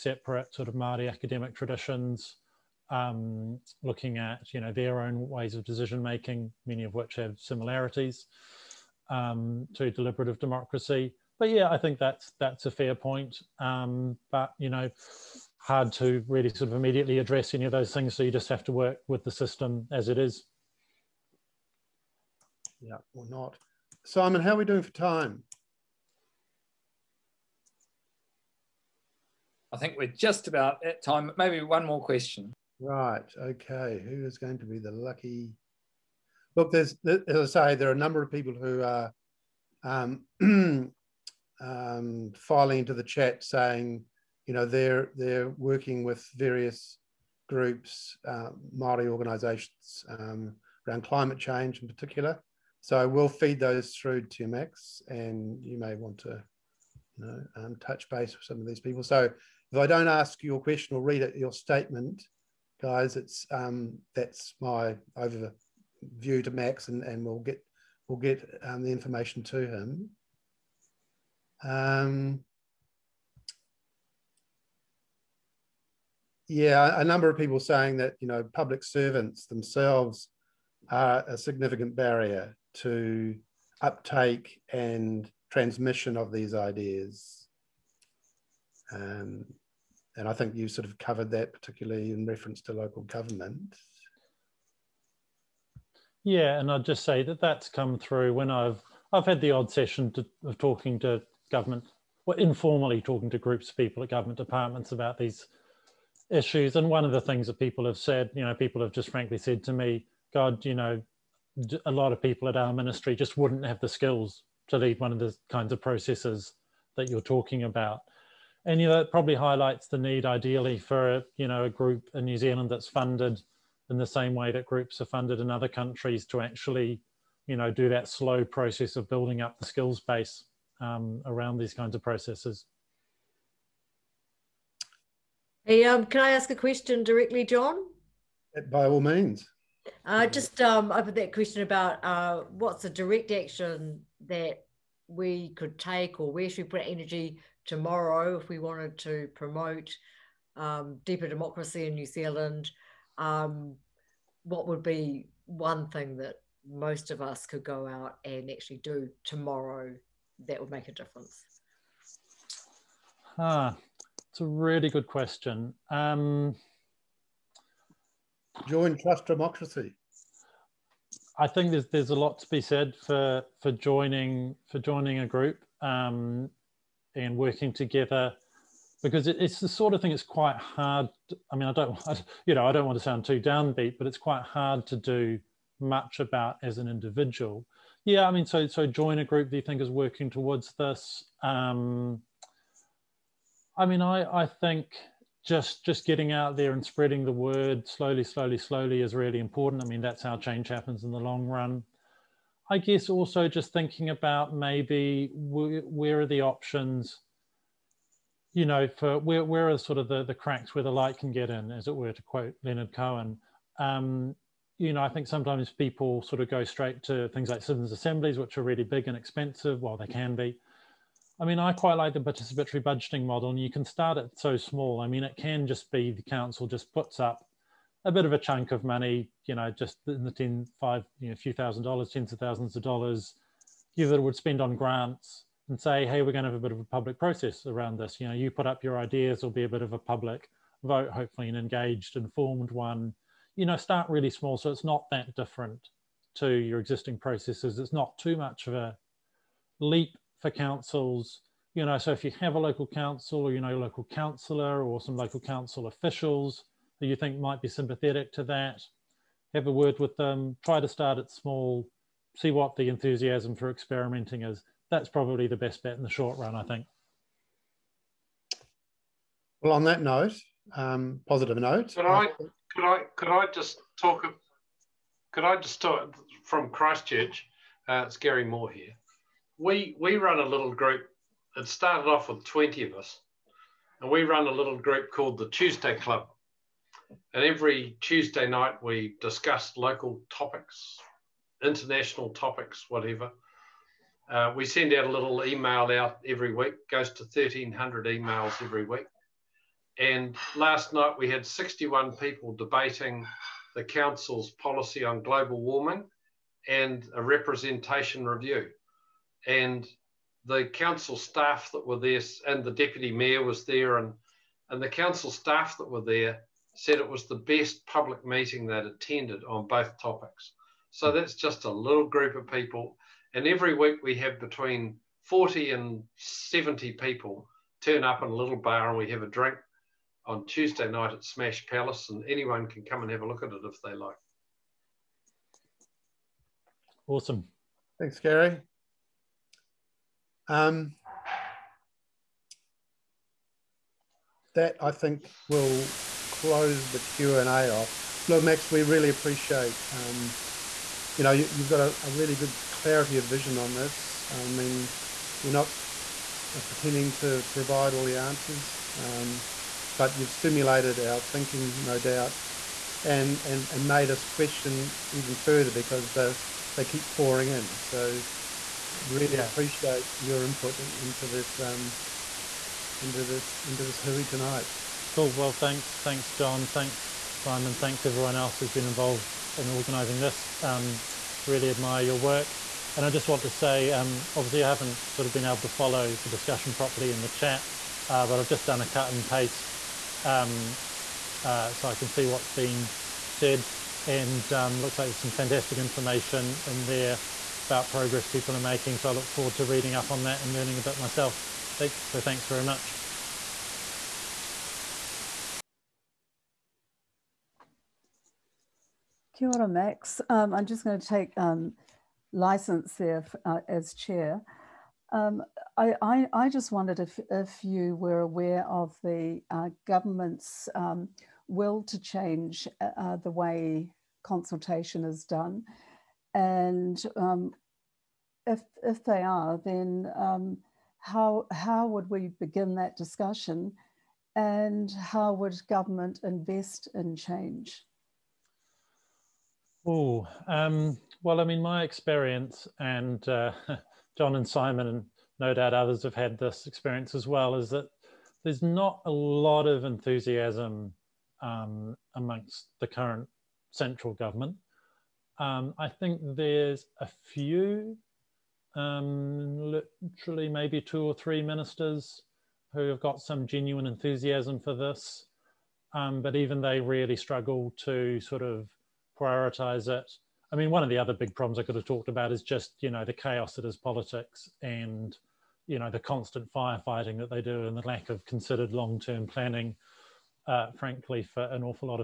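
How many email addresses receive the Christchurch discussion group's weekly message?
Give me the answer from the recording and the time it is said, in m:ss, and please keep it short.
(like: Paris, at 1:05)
1,300, at 4:57.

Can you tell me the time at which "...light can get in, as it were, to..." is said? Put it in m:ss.
3:30.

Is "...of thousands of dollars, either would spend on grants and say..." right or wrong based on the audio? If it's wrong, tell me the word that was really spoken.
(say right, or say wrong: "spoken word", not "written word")
right.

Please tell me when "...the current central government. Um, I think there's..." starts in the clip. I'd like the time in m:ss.
7:32.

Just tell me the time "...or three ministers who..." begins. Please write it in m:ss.
7:41.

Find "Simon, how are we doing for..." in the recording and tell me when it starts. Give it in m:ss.
0:24.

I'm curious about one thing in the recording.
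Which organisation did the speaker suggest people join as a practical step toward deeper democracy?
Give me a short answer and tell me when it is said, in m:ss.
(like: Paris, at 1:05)
Trust Democracy, at 2:48.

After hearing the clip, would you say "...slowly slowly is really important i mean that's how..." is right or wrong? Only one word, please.
right.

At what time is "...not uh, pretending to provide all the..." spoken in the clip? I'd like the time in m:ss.
5:55.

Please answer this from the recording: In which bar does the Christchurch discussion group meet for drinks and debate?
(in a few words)
Smash Palace.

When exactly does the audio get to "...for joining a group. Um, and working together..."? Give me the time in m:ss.
2:54.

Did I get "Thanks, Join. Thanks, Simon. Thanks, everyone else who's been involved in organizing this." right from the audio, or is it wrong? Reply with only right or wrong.
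wrong.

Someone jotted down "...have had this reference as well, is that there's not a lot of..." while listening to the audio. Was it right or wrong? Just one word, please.
wrong.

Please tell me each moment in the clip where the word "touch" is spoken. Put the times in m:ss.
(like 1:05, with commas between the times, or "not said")
0:57.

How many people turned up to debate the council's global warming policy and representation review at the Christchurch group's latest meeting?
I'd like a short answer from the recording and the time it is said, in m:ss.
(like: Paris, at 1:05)
61, at 5:01.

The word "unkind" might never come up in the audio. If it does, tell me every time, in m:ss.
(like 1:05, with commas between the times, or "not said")
not said.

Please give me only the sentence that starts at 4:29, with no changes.
Well, on that note, um, positive note.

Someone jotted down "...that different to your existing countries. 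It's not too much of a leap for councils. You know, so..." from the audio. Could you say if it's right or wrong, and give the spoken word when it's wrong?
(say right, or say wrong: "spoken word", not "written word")
wrong: "processes", not "countries".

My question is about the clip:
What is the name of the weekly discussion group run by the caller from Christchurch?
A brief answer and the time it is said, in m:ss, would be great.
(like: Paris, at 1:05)
the Tuesday Club, at 4:45.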